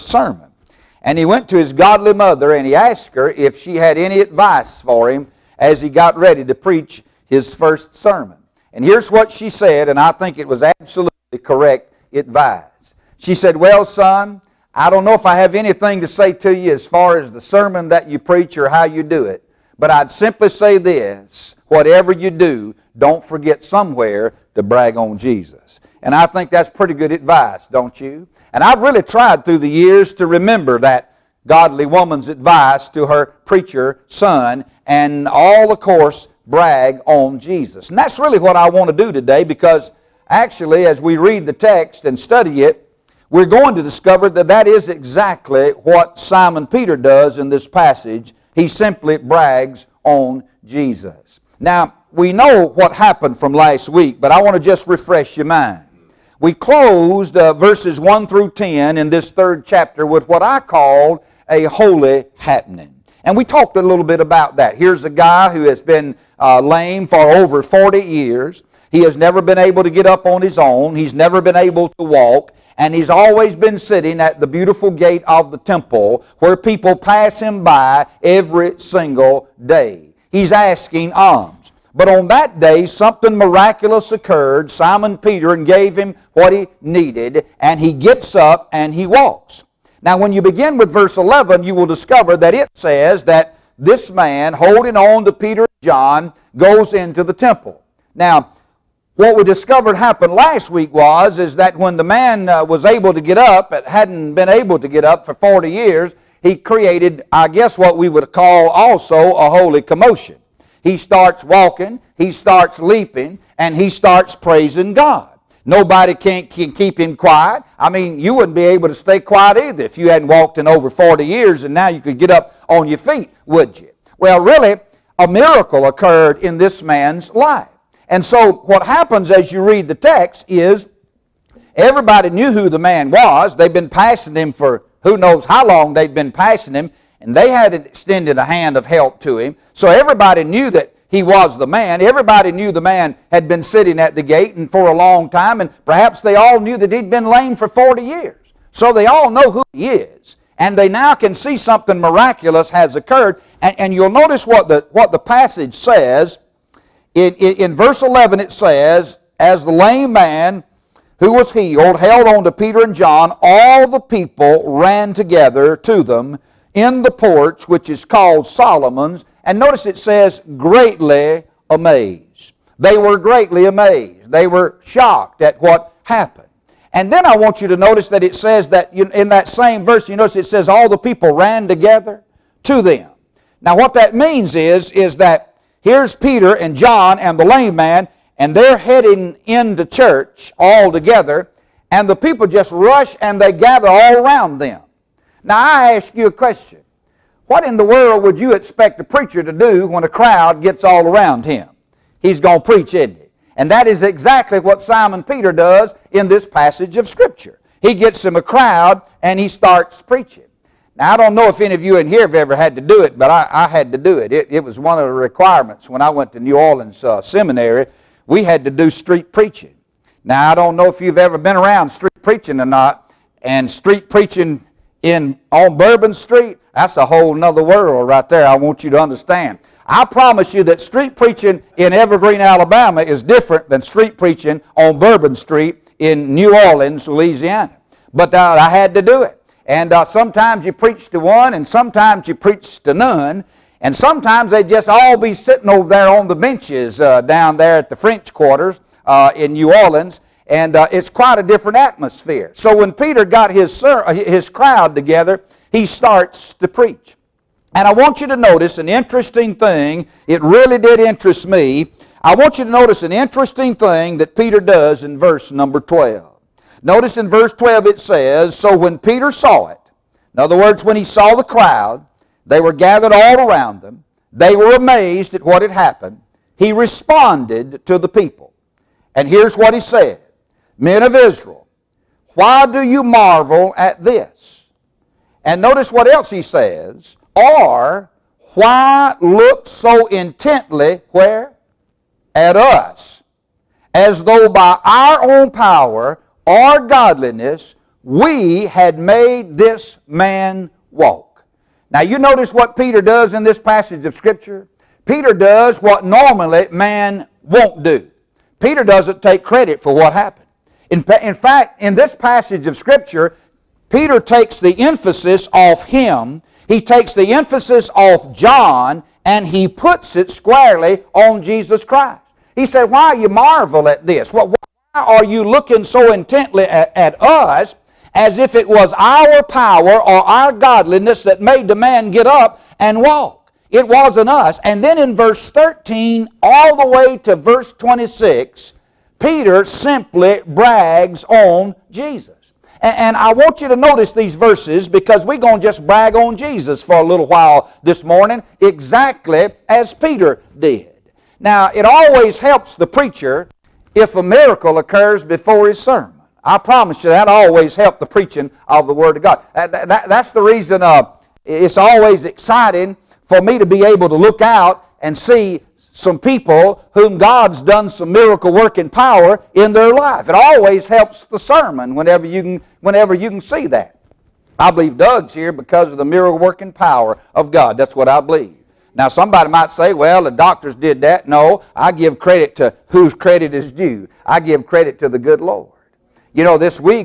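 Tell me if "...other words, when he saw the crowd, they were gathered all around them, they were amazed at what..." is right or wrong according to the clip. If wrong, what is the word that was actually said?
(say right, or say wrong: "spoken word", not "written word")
right.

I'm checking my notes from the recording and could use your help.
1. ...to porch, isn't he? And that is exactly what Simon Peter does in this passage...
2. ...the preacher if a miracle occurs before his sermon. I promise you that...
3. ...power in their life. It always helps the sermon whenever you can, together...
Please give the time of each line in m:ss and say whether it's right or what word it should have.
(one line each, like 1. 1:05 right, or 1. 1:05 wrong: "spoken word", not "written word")
1. 3:22 wrong: "preach", not "porch"
2. 5:52 right
3. 6:08 wrong: "whenever", not "together".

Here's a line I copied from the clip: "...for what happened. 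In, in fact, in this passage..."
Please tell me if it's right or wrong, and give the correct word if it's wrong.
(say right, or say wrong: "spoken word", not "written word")
right.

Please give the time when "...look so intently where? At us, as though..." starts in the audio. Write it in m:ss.
4:49.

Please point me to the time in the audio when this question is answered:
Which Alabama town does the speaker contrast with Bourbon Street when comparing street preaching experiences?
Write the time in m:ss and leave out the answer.
3:51.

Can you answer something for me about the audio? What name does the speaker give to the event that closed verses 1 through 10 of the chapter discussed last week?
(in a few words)
A holy happening.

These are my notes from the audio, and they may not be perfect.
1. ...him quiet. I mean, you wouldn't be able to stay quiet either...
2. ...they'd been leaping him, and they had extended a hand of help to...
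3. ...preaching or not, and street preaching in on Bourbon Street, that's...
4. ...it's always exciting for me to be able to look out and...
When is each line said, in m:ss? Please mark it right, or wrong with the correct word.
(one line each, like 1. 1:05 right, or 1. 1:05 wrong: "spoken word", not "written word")
1. 1:56 right
2. 2:15 wrong: "passing", not "leaping"
3. 3:42 right
4. 6:01 right.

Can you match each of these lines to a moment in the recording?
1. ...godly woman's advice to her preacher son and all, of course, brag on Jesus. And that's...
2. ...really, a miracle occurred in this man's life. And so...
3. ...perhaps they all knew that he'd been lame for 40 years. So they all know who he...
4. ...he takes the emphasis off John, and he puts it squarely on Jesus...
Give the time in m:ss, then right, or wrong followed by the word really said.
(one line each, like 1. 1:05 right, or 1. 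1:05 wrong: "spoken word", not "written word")
1. 0:31 right
2. 2:04 right
3. 2:25 right
4. 5:16 right.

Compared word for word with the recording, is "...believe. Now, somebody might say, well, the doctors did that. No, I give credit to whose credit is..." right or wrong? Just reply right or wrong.
right.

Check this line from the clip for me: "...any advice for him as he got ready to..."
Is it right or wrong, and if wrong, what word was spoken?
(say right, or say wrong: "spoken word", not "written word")
right.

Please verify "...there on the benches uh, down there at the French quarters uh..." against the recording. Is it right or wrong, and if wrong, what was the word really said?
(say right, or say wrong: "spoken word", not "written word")
right.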